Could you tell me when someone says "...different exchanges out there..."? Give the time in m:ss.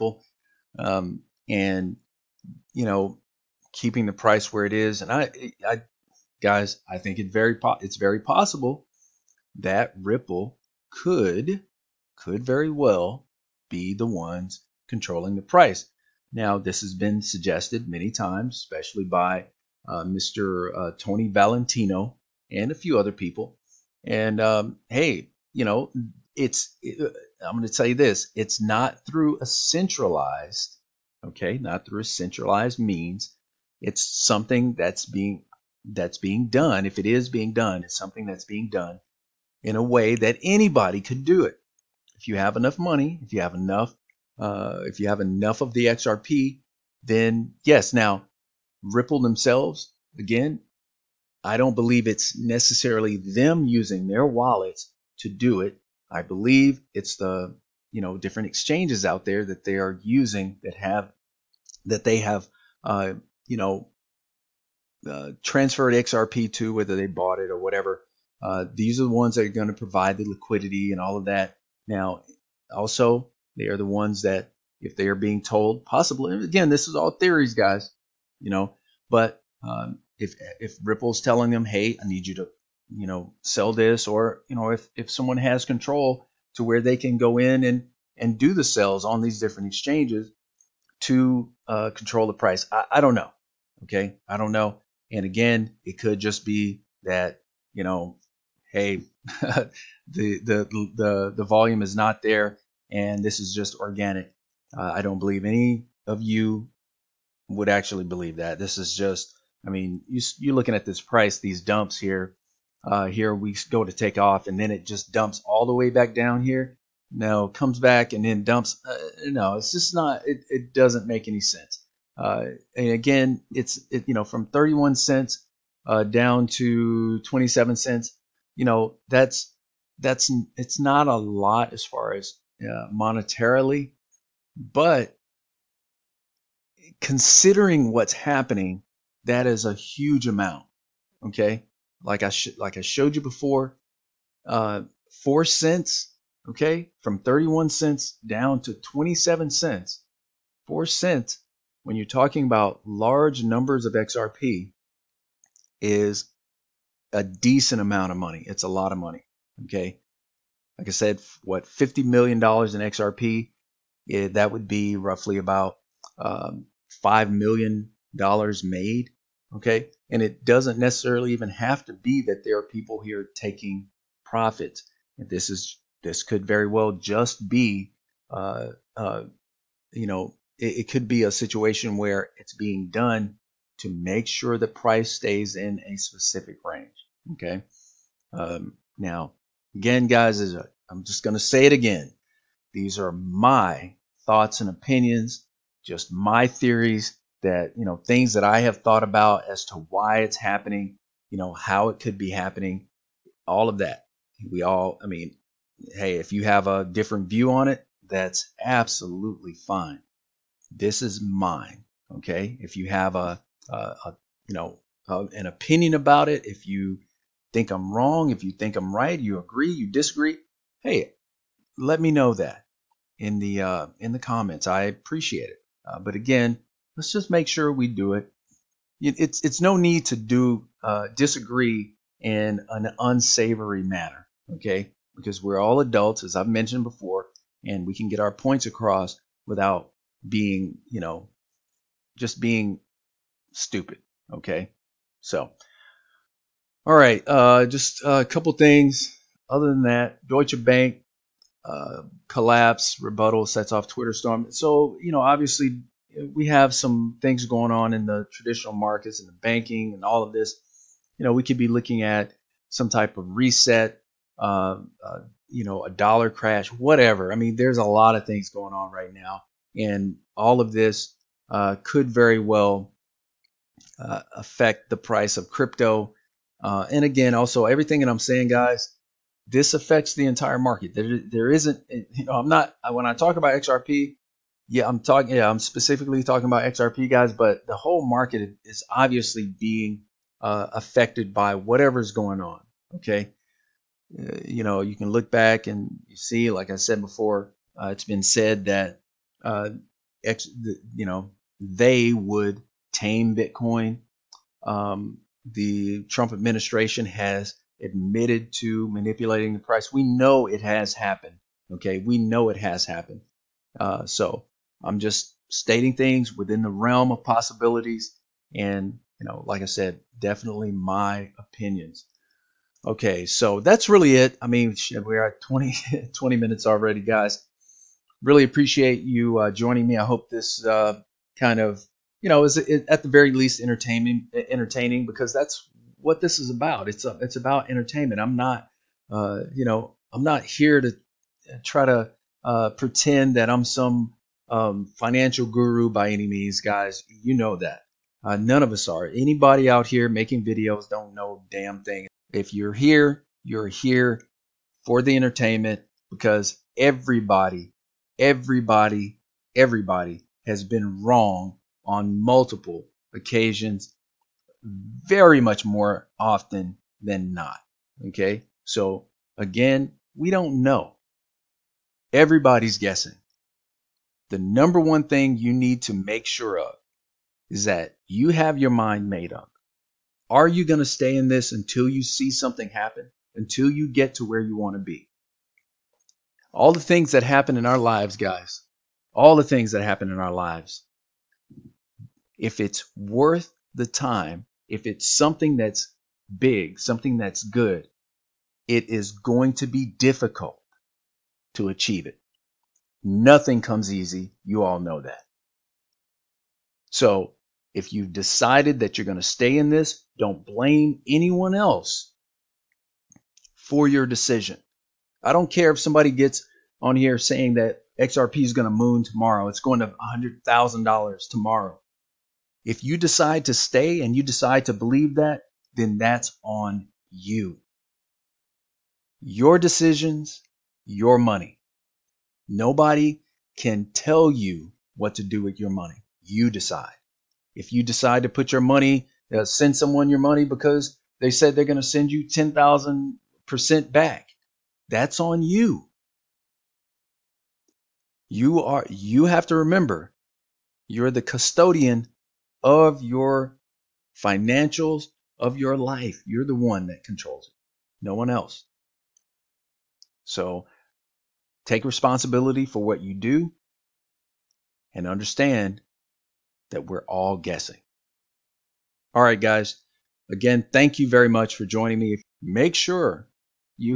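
0:58.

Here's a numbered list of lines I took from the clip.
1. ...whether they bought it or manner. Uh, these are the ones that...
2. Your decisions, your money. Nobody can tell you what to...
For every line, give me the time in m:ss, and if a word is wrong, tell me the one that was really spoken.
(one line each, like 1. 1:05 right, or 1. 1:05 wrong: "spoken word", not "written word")
1. 1:06 wrong: "whatever", not "manner"
2. 7:09 right.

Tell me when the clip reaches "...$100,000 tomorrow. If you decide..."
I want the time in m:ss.
6:59.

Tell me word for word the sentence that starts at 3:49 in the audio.
It's it's no need to do uh, disagree in an unsavory manner, okay?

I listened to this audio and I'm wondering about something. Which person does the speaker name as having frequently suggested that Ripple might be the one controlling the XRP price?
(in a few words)
Tony Valentino.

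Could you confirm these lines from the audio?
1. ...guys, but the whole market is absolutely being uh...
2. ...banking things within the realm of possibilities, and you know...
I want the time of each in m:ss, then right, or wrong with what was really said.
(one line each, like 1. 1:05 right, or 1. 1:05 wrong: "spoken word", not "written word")
1. 4:47 wrong: "obviously", not "absolutely"
2. 5:15 wrong: "stating", not "banking".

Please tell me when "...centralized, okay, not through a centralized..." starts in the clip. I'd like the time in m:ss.
0:29.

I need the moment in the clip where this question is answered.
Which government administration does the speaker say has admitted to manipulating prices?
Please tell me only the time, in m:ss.
5:06.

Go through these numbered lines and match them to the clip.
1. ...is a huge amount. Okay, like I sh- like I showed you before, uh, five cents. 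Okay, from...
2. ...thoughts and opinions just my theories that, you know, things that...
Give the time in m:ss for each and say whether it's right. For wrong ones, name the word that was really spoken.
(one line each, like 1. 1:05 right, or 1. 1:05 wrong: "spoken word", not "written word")
1. 2:19 wrong: "four", not "five"
2. 3:14 right.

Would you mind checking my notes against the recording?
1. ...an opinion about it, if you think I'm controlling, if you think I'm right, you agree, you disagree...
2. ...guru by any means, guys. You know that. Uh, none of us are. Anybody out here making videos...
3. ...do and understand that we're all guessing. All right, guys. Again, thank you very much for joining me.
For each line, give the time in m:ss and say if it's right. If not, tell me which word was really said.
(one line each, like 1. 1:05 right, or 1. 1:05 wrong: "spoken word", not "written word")
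1. 3:35 wrong: "wrong", not "controlling"
2. 5:45 right
3. 7:43 right.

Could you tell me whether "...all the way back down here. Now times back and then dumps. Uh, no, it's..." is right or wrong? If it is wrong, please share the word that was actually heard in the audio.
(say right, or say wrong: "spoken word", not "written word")
wrong: "comes", not "times".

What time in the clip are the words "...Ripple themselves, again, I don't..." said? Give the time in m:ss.
0:48.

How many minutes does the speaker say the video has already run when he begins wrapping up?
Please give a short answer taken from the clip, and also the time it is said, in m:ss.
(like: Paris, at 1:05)
20 minutes, at 5:26.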